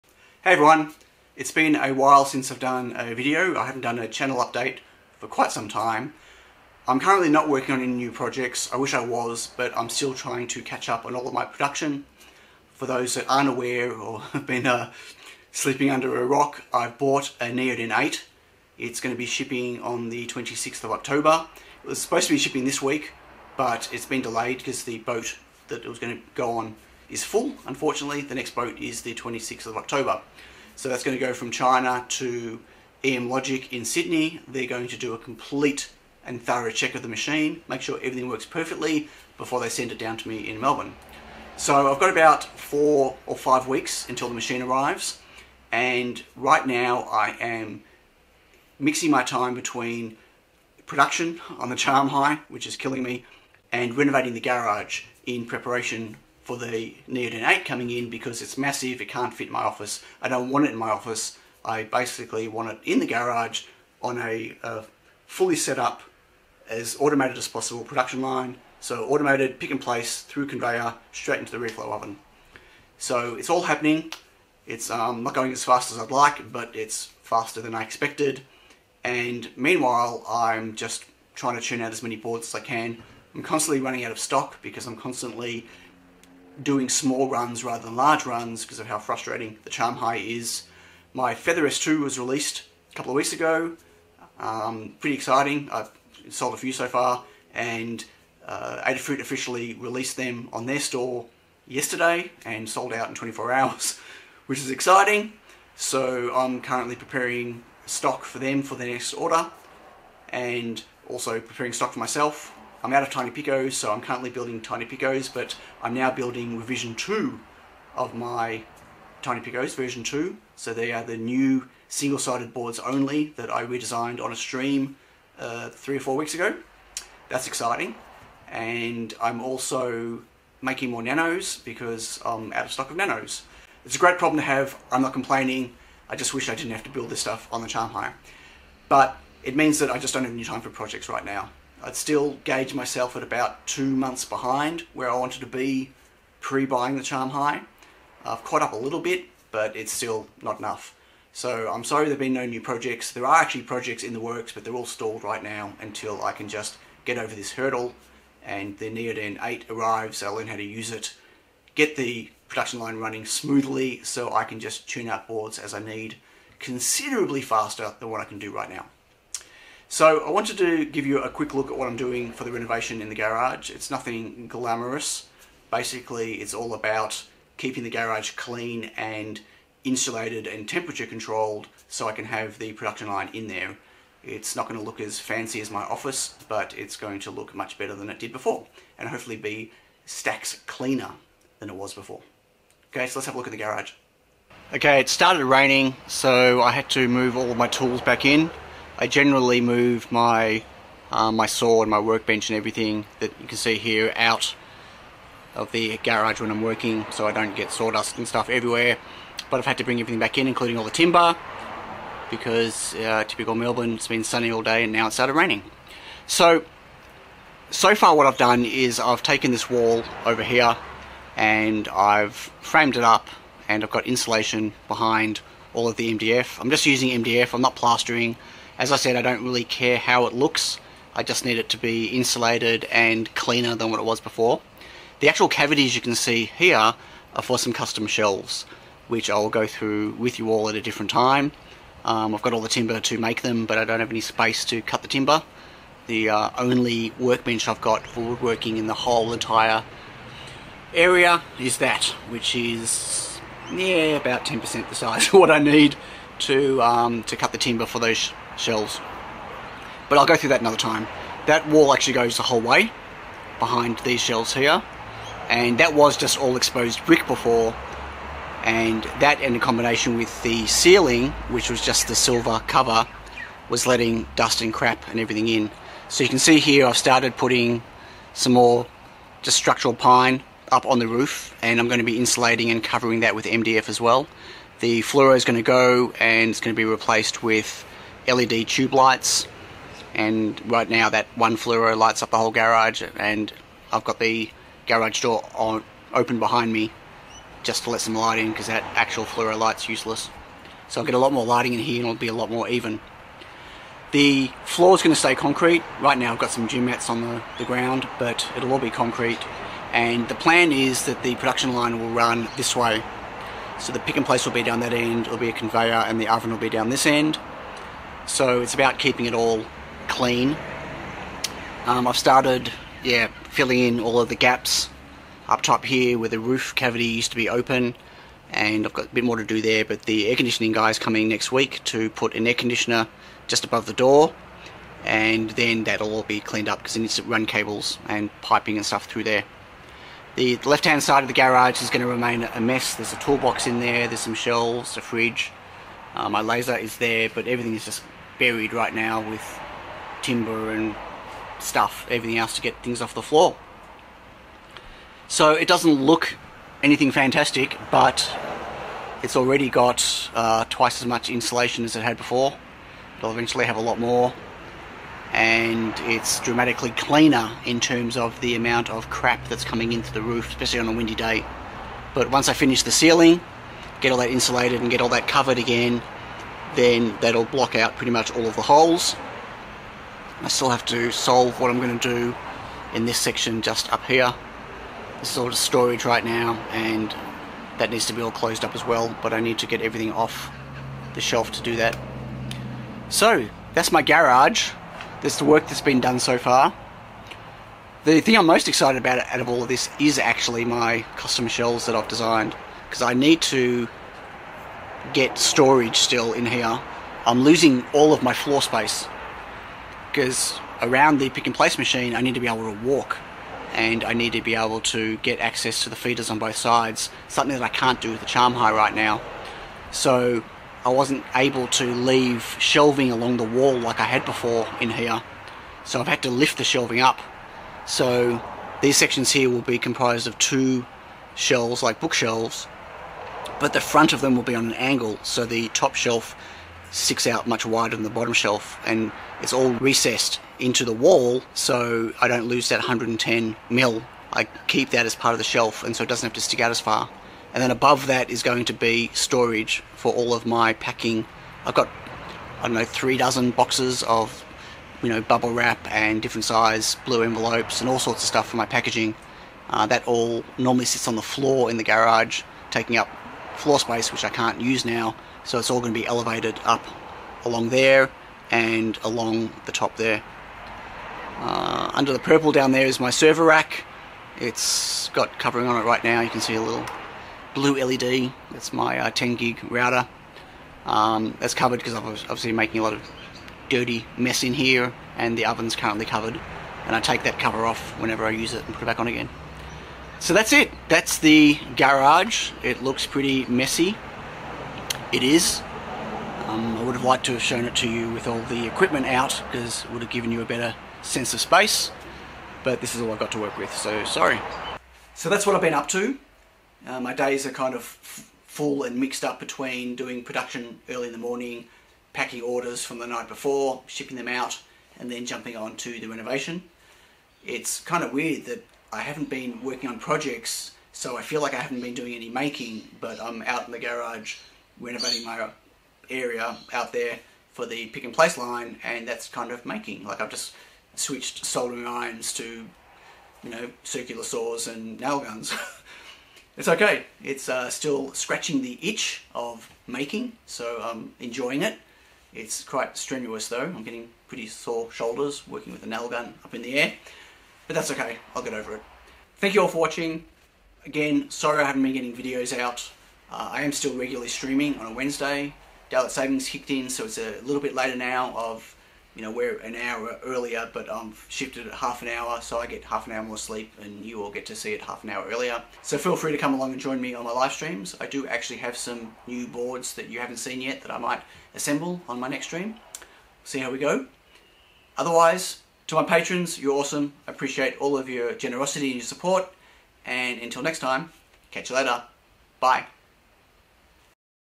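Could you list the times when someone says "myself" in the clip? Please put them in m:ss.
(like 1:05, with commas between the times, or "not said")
1:51, 2:22.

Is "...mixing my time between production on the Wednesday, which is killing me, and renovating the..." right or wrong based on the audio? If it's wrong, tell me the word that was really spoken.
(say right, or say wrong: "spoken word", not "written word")
wrong: "CharmHigh", not "Wednesday".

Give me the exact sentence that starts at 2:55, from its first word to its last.
Basically, it's all about keeping the garage clean and insulated and temperature controlled so I can have the production line in there.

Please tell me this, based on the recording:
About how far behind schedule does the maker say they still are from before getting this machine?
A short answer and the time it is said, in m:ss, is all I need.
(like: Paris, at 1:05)
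2 months, at 2:23.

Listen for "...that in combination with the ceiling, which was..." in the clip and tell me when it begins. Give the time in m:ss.
4:29.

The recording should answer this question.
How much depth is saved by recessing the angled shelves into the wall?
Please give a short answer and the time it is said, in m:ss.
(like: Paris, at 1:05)
110 mm, at 7:22.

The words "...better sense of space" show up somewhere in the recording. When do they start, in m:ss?
8:20.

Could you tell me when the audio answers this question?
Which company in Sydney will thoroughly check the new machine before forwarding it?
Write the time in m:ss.
0:33.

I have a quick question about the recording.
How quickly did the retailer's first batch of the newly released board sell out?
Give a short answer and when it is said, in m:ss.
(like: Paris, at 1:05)
24 hours, at 1:43.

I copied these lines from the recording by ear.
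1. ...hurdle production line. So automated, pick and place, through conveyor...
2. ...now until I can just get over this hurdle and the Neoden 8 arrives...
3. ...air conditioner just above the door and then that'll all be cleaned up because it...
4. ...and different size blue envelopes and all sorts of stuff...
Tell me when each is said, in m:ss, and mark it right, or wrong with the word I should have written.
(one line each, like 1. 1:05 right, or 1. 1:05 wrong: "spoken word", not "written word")
1. 1:07 wrong: "possible", not "hurdle"
2. 2:35 right
3. 5:32 right
4. 7:35 right.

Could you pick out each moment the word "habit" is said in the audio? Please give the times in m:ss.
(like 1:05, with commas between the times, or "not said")
not said.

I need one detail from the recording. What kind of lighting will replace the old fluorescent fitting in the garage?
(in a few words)
LED tube lights.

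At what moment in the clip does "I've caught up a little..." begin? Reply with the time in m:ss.
2:28.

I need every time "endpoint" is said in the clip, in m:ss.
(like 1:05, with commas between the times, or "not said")
not said.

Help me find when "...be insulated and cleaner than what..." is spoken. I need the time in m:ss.
3:51.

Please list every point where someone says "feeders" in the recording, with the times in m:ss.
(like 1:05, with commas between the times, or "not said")
6:55.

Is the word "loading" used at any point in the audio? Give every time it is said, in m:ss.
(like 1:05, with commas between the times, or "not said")
not said.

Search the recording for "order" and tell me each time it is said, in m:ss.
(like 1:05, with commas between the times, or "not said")
1:49, 8:32.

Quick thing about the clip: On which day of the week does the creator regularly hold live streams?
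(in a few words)
Wednesday.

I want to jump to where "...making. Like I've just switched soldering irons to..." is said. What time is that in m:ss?
8:49.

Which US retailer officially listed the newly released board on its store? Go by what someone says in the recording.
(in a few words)
Adafruit.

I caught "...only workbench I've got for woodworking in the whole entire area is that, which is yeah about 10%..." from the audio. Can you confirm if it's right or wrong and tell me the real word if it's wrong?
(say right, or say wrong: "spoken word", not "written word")
right.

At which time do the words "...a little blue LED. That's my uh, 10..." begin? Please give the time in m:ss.
7:56.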